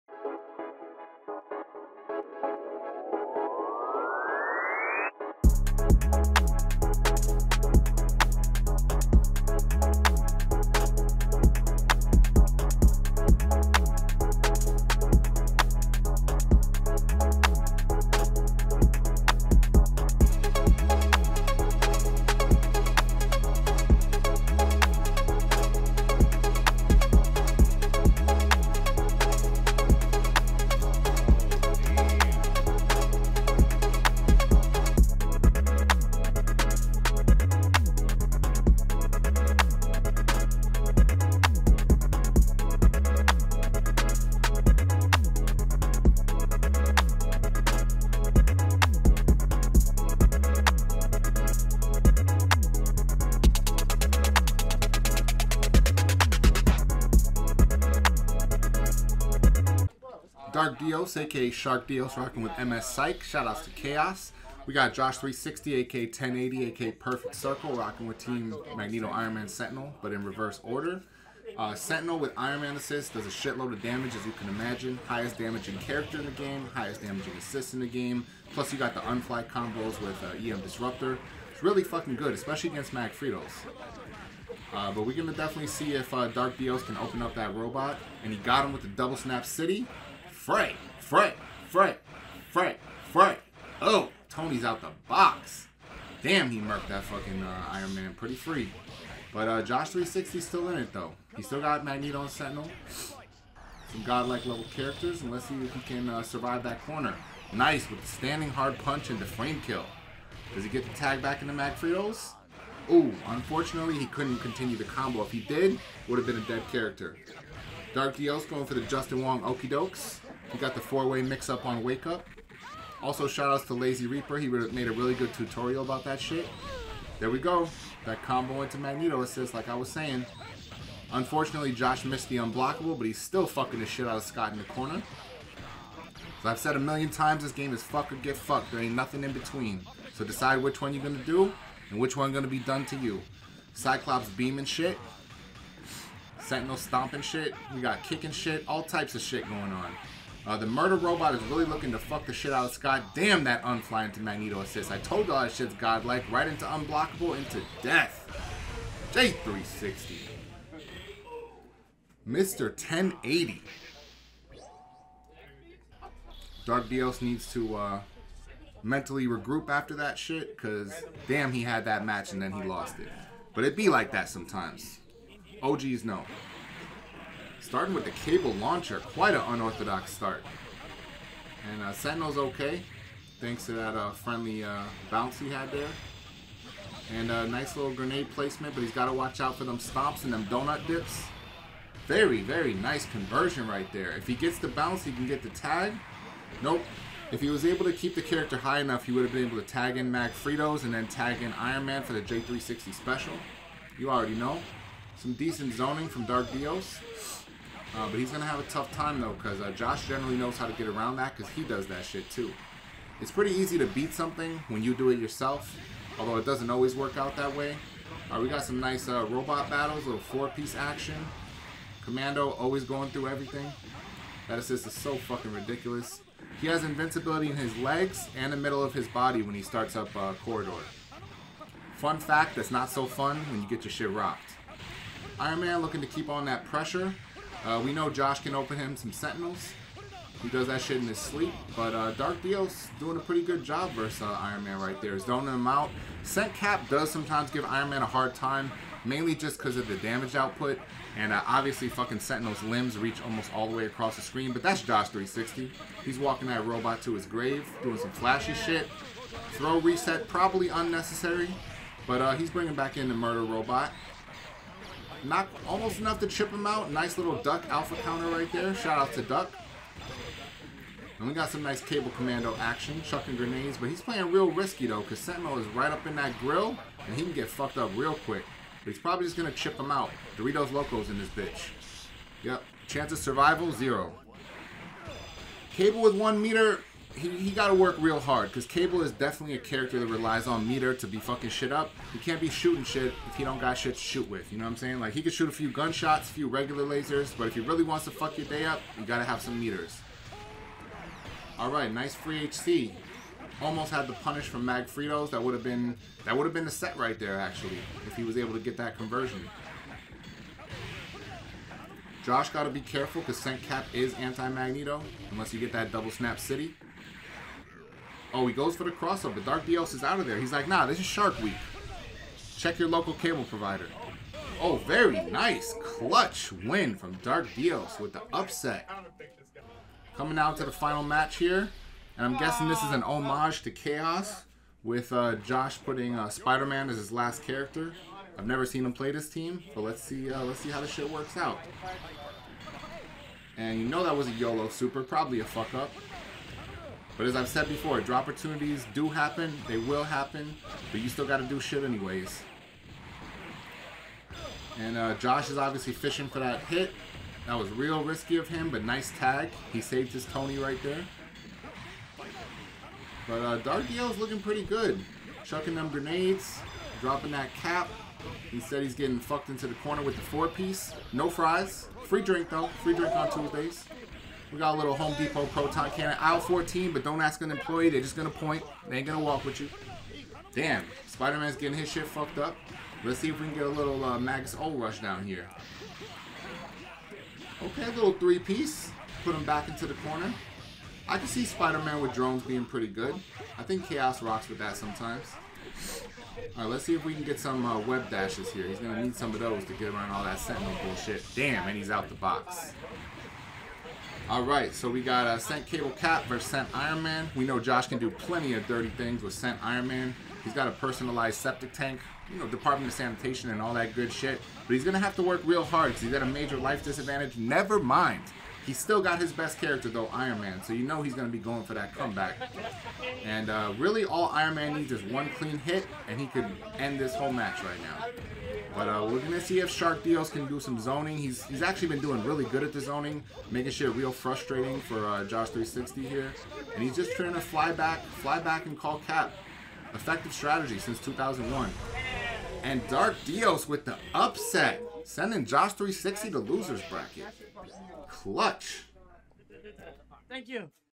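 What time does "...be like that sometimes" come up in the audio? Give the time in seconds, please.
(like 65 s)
173 s.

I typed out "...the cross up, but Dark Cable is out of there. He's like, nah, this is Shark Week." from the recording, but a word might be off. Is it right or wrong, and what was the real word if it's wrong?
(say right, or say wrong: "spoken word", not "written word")
wrong: "Dios", not "Cable".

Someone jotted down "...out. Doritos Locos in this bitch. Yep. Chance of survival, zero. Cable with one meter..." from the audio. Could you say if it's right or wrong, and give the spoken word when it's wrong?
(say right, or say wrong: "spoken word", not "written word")
right.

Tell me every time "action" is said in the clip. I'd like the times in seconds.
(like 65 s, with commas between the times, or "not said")
220 s, 272 s.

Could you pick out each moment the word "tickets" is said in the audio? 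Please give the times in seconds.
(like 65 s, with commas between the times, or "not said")
not said.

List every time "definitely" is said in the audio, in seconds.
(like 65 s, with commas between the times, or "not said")
85 s, 289 s.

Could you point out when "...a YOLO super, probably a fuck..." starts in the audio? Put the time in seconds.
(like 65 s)
344 s.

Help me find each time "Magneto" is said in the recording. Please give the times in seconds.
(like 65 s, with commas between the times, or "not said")
68 s, 101 s, 128 s, 154 s, 314 s.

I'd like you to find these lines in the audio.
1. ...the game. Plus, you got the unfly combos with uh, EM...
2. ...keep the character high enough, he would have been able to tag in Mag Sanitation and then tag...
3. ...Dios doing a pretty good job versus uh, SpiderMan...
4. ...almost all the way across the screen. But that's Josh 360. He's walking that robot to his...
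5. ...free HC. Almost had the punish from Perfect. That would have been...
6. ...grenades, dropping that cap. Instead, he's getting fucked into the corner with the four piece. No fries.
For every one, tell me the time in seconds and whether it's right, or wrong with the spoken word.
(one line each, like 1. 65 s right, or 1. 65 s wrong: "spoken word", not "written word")
1. 77 s right
2. 197 s wrong: "Fritos", not "Sanitation"
3. 242 s wrong: "Iron", not "SpiderMan"
4. 253 s right
5. 302 s wrong: "Magfritos", not "Perfect"
6. 365 s right.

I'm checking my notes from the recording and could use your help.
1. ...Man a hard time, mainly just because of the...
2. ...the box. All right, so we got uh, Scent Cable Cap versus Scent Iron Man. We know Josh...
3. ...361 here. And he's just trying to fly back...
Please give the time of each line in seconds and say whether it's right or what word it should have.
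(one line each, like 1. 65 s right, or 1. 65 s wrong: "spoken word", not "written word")
1. 247 s right
2. 402 s right
3. 435 s wrong: "360", not "361".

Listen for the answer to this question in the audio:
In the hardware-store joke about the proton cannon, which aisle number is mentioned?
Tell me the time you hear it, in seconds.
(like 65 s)
376 s.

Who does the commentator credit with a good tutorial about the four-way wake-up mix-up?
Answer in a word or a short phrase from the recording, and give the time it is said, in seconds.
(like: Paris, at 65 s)
Lazy Reaper, at 123 s.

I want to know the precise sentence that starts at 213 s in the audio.
It's pretty easy to beat something when you do it yourself, although it doesn't always work out that way.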